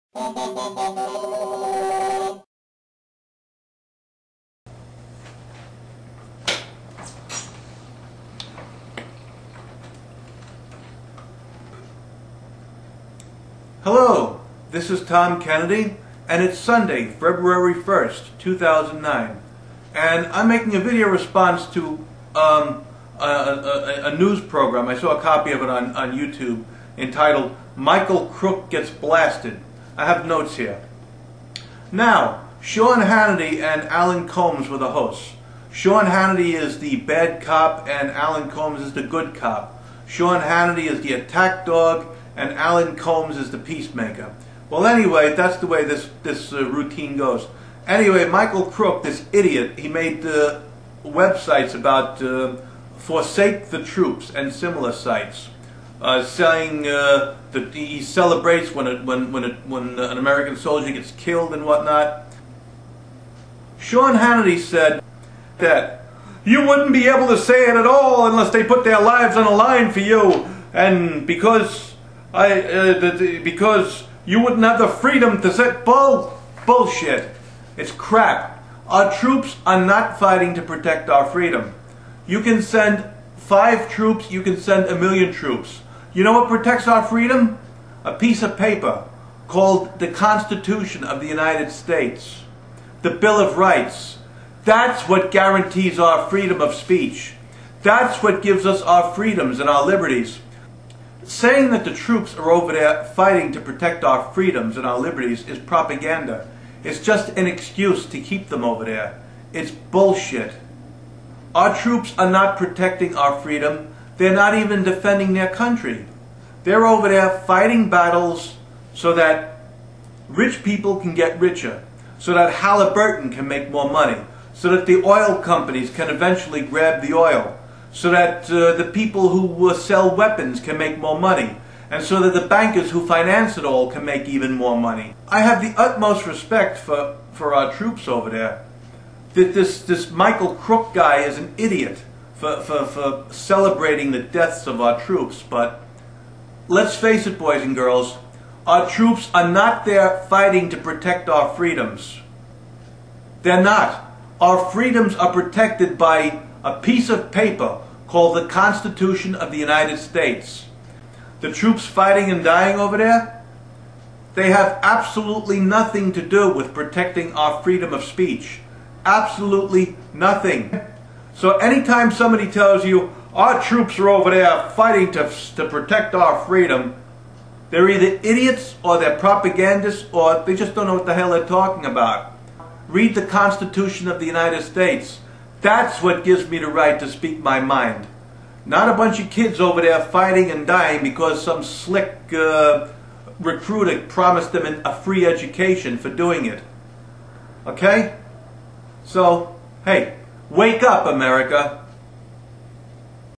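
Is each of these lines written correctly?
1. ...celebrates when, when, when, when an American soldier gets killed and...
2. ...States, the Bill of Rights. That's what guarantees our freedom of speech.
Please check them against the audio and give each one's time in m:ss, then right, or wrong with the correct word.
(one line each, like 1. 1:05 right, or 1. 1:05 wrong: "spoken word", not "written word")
1. 0:58 right
2. 1:31 right.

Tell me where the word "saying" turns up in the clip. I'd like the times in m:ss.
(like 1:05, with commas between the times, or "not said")
0:56, 1:41.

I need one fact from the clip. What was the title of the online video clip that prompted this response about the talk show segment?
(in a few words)
Michael Crook Gets Blasted.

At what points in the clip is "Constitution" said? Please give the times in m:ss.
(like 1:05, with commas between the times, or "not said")
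1:30, 2:38, 3:03.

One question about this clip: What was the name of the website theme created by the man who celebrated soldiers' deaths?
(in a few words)
Forsake the Troops.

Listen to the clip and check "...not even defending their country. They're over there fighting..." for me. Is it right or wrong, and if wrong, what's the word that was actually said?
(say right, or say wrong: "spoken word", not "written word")
right.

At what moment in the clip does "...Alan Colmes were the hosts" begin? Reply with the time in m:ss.
0:33.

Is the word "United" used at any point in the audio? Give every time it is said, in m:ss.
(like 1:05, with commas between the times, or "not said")
1:31, 2:39, 3:04.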